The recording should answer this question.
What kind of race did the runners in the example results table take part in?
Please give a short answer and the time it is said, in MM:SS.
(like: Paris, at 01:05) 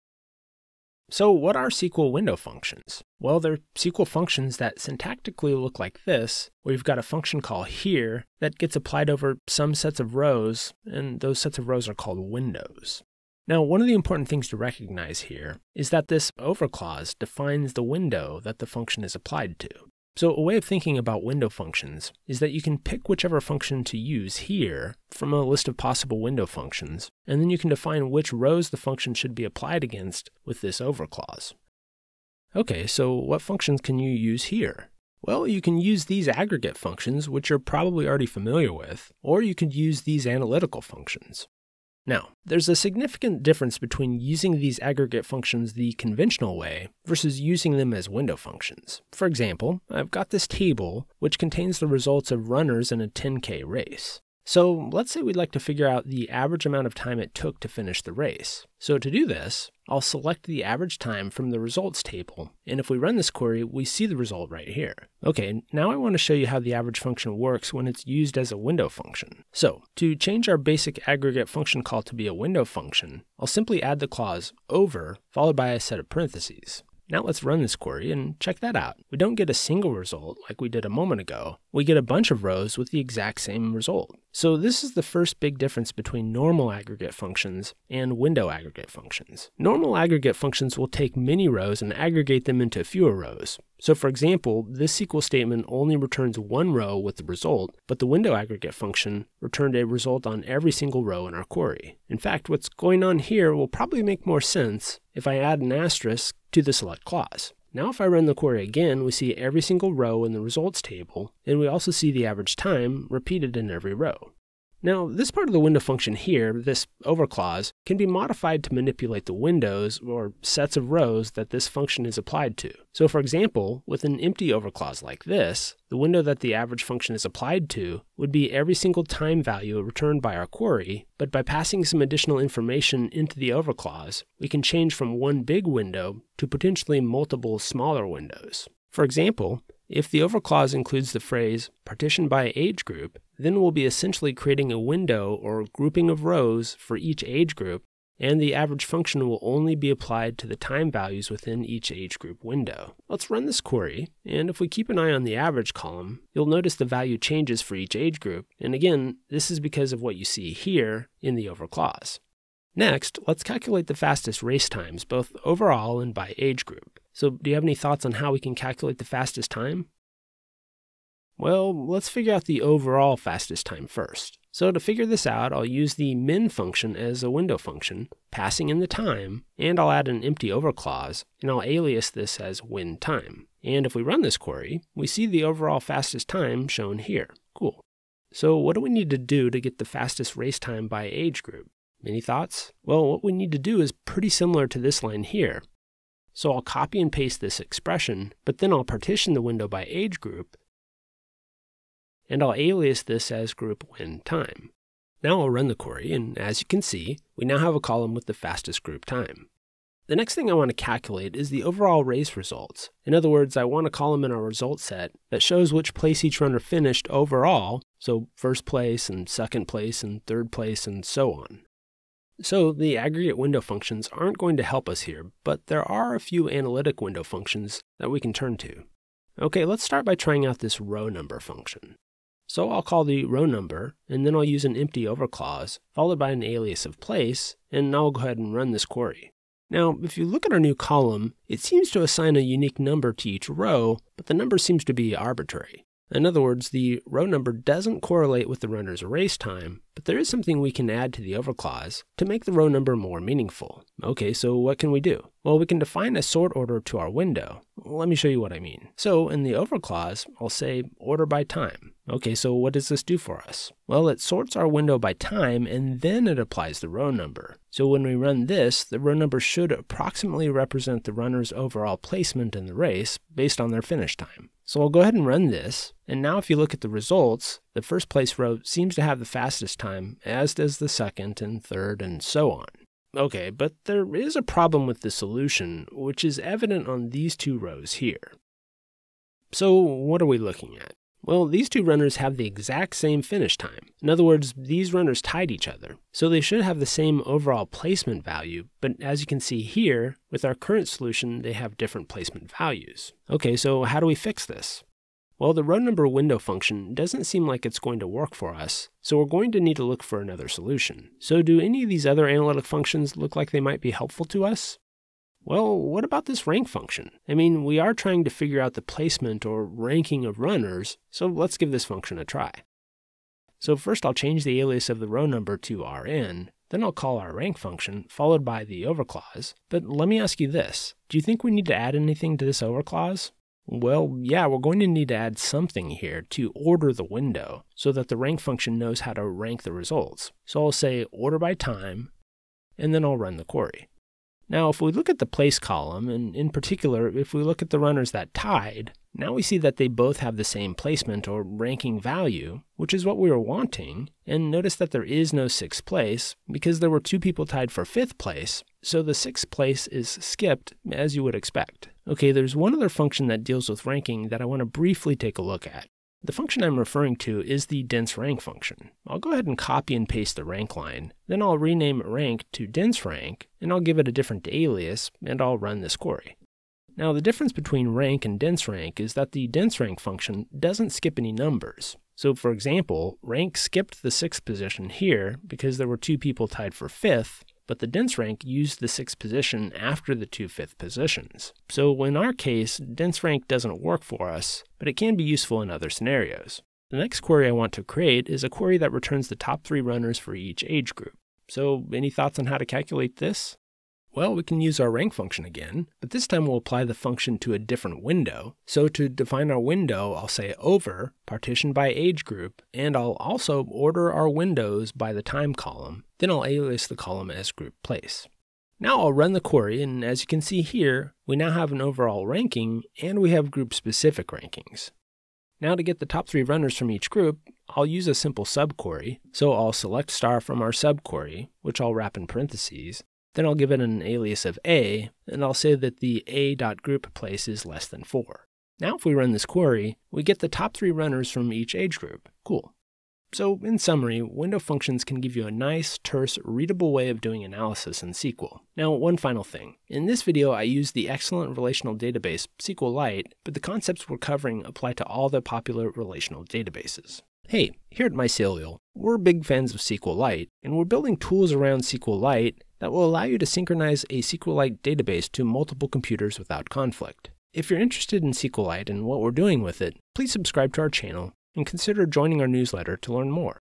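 10K race, at 00:53.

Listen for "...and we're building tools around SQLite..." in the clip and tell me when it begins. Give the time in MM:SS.
07:40.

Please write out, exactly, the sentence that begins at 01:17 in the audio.
Now let's run this query and check that out.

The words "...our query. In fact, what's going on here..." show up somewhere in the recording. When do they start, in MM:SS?
01:41.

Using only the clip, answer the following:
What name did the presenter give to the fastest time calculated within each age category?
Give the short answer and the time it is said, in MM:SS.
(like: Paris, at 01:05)
group win time, at 03:23.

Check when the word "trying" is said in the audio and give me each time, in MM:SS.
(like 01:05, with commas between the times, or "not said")
03:50, 05:17.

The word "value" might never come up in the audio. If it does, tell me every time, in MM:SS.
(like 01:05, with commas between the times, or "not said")
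02:09, 02:30, 02:36, 04:58, 05:02, 05:52.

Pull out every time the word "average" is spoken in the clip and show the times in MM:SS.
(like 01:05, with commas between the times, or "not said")
00:56, 01:00, 01:06, 01:52, 02:06, 02:28, 02:35.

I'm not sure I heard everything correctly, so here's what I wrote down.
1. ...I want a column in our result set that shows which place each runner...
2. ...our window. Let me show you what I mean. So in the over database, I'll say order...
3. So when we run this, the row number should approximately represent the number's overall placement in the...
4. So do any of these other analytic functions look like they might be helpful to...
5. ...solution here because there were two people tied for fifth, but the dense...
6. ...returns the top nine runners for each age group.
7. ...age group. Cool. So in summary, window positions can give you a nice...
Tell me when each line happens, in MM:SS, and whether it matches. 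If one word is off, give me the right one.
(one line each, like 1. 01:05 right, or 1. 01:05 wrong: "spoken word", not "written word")
1. 03:33 right
2. 04:16 wrong: "clause", not "database"
3. 04:27 wrong: "runner", not "number"
4. 05:11 right
5. 06:24 wrong: "position", not "solution"
6. 06:38 wrong: "three", not "nine"
7. 07:21 wrong: "functions", not "positions".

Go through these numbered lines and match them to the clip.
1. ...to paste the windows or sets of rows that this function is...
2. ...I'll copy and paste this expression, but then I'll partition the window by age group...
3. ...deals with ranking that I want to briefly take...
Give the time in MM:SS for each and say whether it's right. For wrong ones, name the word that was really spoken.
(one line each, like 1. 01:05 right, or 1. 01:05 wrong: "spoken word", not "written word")
1. 01:58 wrong: "manipulate", not "paste"
2. 03:16 right
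3. 06:03 right.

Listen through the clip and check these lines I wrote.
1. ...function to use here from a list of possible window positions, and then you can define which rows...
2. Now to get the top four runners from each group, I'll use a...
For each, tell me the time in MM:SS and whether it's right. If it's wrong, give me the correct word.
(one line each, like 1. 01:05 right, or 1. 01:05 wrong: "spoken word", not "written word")
1. 00:23 wrong: "functions", not "positions"
2. 07:05 wrong: "three", not "four".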